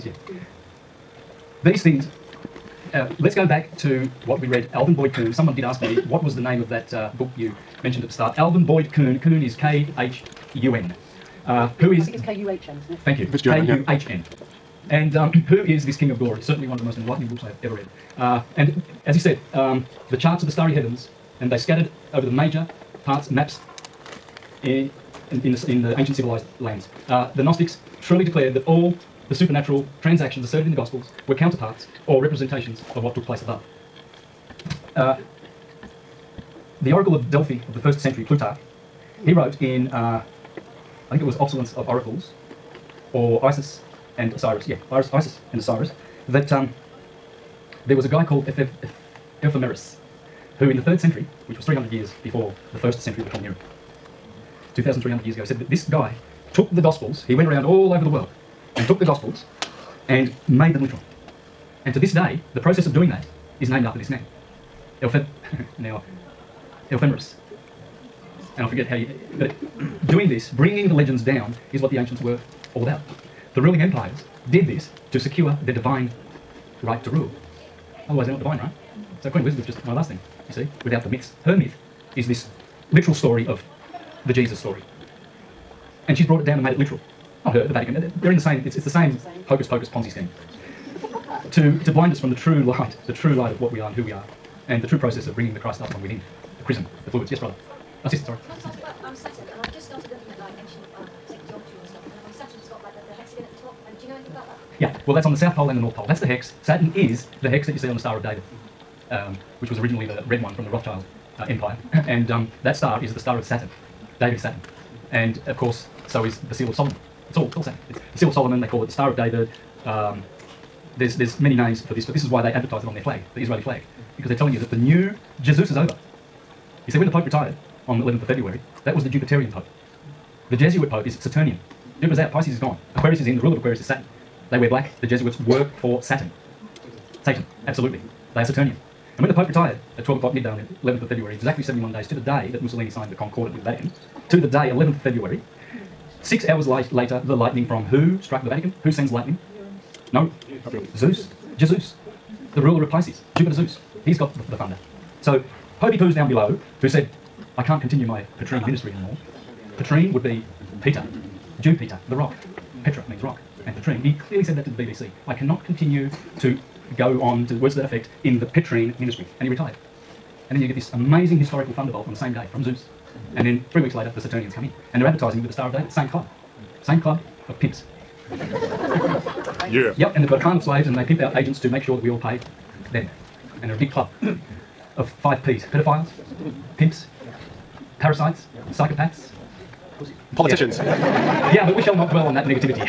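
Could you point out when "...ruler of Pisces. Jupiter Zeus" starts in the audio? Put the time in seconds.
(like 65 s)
152 s.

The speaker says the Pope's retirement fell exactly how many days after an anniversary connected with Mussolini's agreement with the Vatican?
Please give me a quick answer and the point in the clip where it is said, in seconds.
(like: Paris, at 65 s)
71, at 141 s.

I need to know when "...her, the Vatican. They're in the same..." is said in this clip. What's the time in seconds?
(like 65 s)
87 s.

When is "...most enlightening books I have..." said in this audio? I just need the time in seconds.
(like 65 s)
16 s.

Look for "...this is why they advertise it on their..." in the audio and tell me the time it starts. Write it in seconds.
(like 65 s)
122 s.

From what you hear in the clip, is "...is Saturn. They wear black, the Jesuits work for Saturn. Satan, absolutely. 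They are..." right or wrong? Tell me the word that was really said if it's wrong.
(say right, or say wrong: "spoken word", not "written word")
right.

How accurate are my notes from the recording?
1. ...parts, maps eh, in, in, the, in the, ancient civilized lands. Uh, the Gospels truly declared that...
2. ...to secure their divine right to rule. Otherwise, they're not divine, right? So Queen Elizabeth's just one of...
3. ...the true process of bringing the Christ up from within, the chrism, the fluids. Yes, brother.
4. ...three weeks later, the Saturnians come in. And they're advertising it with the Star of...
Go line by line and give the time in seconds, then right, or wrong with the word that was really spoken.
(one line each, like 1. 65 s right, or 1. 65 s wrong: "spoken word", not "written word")
1. 23 s wrong: "Gnostics", not "Gospels"
2. 75 s right
3. 94 s right
4. 173 s right.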